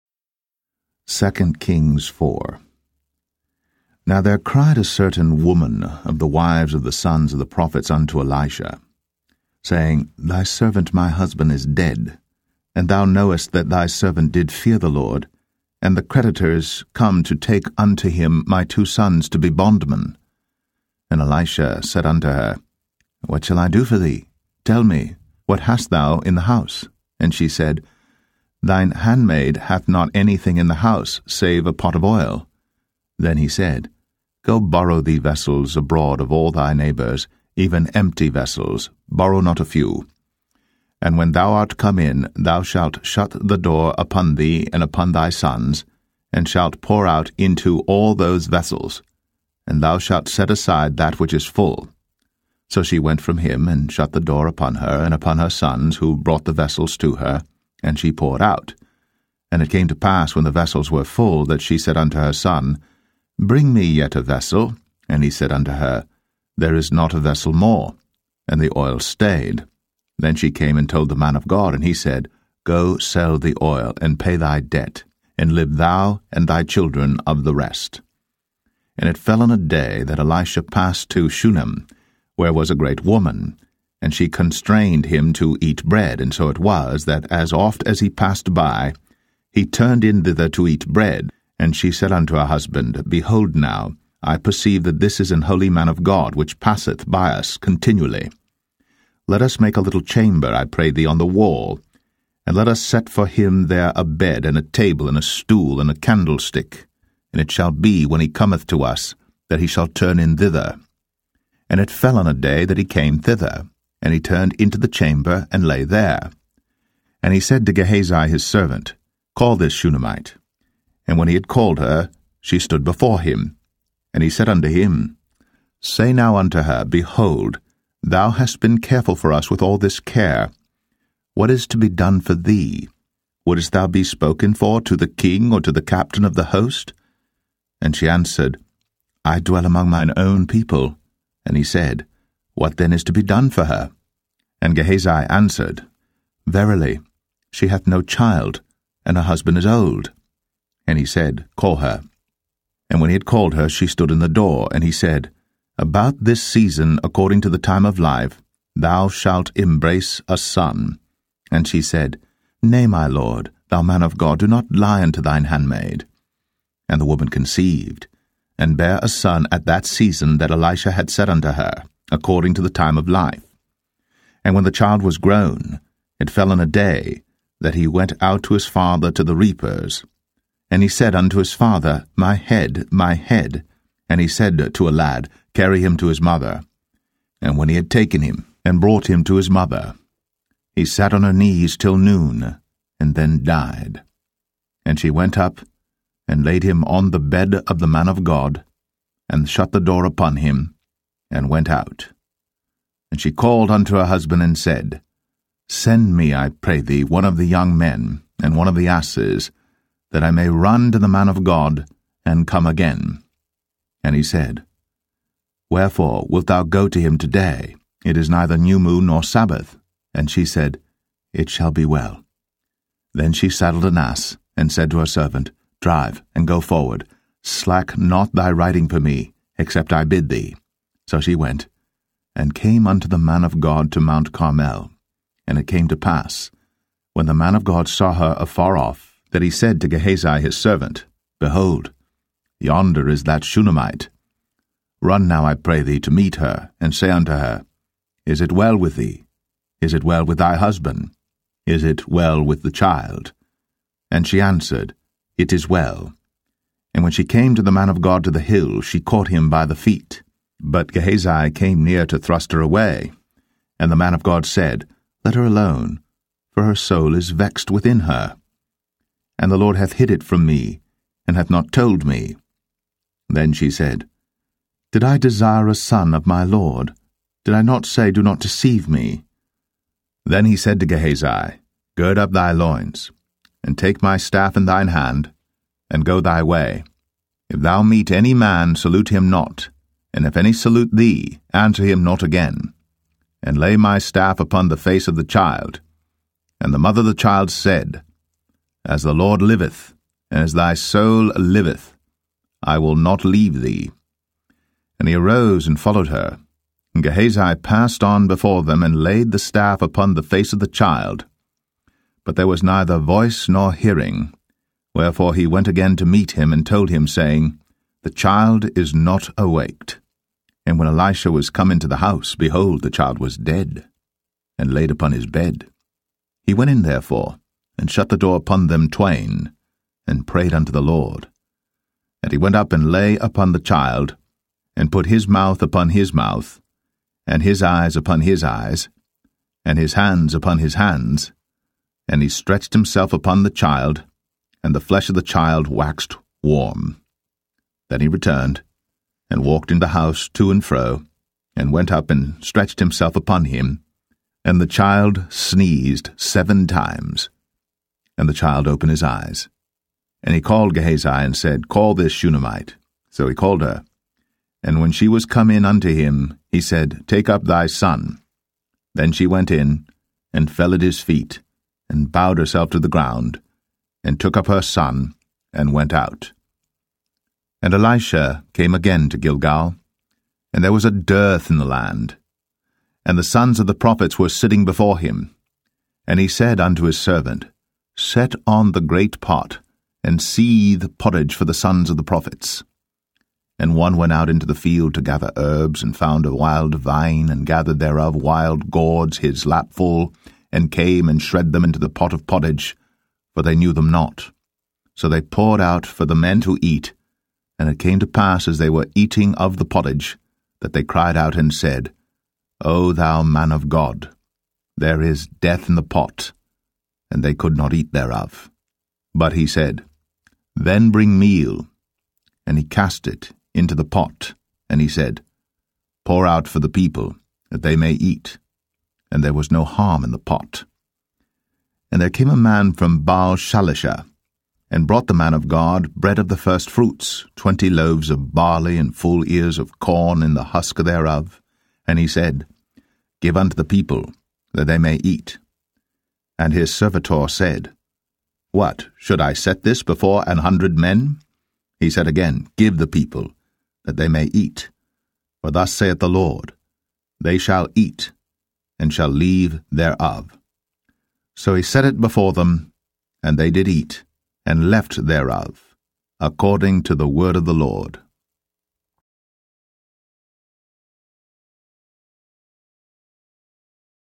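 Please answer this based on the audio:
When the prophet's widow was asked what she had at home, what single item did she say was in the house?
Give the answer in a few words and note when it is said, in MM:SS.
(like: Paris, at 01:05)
a pot of oil, at 00:31.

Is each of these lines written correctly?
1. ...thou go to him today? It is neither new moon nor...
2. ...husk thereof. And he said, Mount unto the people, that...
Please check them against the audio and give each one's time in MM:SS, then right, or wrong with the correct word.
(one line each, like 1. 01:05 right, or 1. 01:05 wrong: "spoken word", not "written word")
1. 03:36 right
2. 07:20 wrong: "Give", not "Mount".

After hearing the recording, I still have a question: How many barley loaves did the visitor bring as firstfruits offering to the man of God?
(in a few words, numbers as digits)
20.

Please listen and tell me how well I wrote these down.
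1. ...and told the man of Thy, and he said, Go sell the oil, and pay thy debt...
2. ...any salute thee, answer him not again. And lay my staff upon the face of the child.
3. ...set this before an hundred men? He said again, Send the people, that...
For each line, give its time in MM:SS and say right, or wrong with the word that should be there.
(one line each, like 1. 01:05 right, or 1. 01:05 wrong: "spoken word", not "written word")
1. 01:10 wrong: "God", not "Thy"
2. 04:50 right
3. 07:29 wrong: "Give", not "Send".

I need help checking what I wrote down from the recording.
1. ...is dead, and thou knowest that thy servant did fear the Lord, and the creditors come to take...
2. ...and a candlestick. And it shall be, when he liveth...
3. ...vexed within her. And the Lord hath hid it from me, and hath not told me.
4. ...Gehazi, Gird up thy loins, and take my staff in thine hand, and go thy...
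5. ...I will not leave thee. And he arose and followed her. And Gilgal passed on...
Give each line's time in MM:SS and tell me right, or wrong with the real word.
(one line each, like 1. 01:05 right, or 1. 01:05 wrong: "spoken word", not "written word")
1. 00:11 right
2. 01:45 wrong: "cometh", not "liveth"
3. 04:27 right
4. 04:40 right
5. 05:02 wrong: "Gehazi", not "Gilgal".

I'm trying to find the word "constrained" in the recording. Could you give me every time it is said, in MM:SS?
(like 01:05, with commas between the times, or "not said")
01:24.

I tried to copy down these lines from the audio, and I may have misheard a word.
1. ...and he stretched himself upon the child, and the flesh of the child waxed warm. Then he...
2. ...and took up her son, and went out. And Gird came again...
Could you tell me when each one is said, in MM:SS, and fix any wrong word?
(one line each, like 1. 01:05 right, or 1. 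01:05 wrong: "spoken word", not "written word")
1. 05:42 right
2. 06:14 wrong: "Elisha", not "Gird".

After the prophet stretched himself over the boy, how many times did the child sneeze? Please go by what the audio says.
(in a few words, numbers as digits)
7.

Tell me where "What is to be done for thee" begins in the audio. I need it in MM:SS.
02:11.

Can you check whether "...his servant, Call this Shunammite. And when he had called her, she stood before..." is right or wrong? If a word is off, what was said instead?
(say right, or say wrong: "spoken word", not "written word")
right.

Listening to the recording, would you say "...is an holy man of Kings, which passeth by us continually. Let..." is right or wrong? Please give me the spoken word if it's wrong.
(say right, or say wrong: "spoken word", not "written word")
wrong: "God", not "Kings".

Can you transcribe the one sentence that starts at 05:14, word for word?
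Wherefore he went again to meet him, and told him, saying, the child is not awaked.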